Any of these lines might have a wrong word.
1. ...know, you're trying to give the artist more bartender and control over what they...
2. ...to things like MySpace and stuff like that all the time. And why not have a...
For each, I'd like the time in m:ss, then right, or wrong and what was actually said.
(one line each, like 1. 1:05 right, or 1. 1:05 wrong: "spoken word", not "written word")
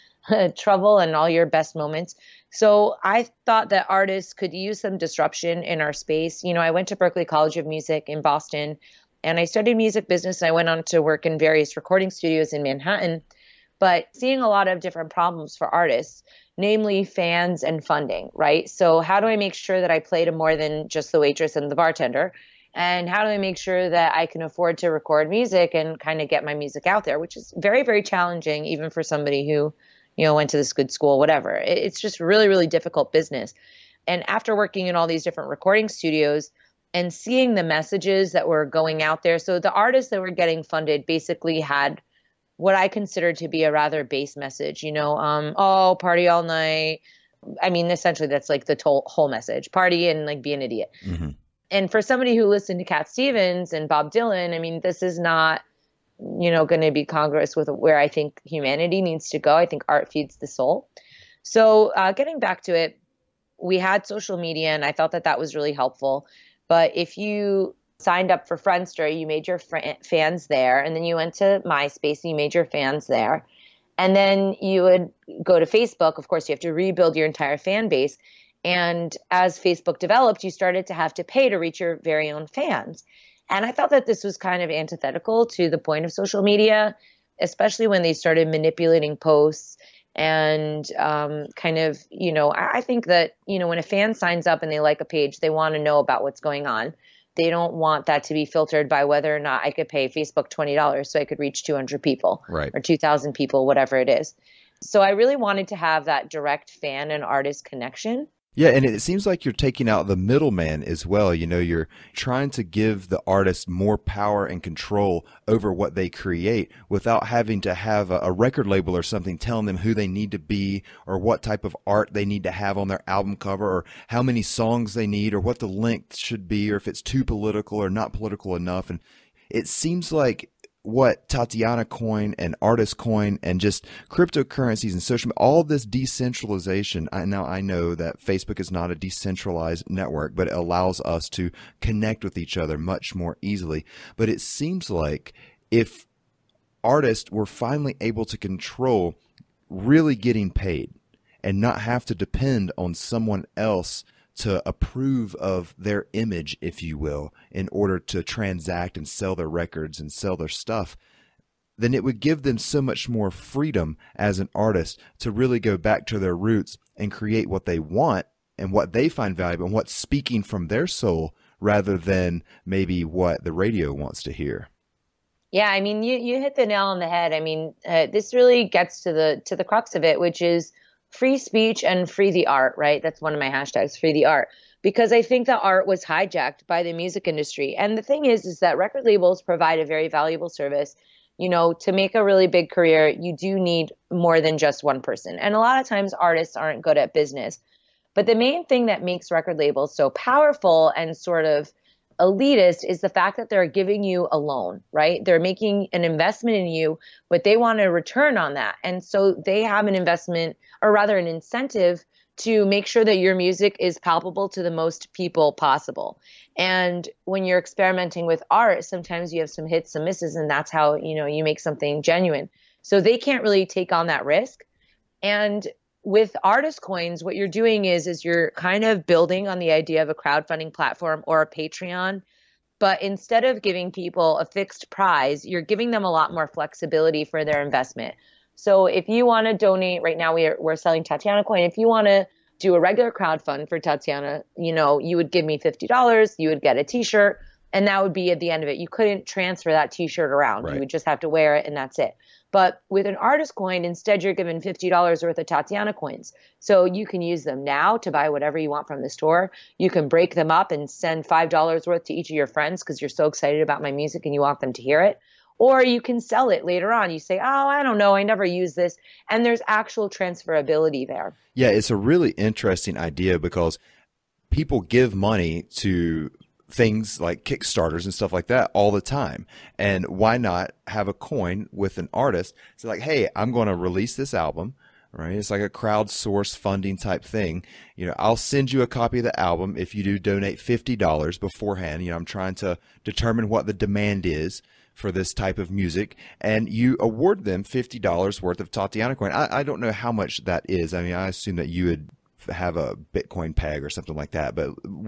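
1. 1:51 wrong: "power", not "bartender"
2. 4:35 wrong: "Kickstarters", not "MySpace".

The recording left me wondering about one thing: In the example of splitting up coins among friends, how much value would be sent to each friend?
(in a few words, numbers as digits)
$5.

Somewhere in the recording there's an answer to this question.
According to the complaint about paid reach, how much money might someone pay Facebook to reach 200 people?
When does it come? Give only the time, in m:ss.
1:40.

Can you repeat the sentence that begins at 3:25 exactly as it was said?
They're making an investment in you, but they want a return on that.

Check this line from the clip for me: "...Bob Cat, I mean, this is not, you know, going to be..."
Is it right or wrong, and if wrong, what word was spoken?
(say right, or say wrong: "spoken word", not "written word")
wrong: "Dylan", not "Cat".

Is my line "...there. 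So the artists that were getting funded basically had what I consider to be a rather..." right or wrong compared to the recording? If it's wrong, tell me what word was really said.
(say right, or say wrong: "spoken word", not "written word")
right.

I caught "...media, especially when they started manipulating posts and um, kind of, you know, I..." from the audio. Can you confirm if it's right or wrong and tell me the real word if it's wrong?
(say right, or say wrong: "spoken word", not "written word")
right.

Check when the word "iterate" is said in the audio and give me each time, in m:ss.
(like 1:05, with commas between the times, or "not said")
not said.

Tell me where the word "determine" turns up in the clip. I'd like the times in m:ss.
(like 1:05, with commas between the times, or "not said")
4:53.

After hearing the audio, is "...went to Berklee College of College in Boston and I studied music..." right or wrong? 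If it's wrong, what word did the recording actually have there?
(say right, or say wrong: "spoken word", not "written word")
wrong: "Music", not "College".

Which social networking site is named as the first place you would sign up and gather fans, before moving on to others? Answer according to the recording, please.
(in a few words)
Friendster.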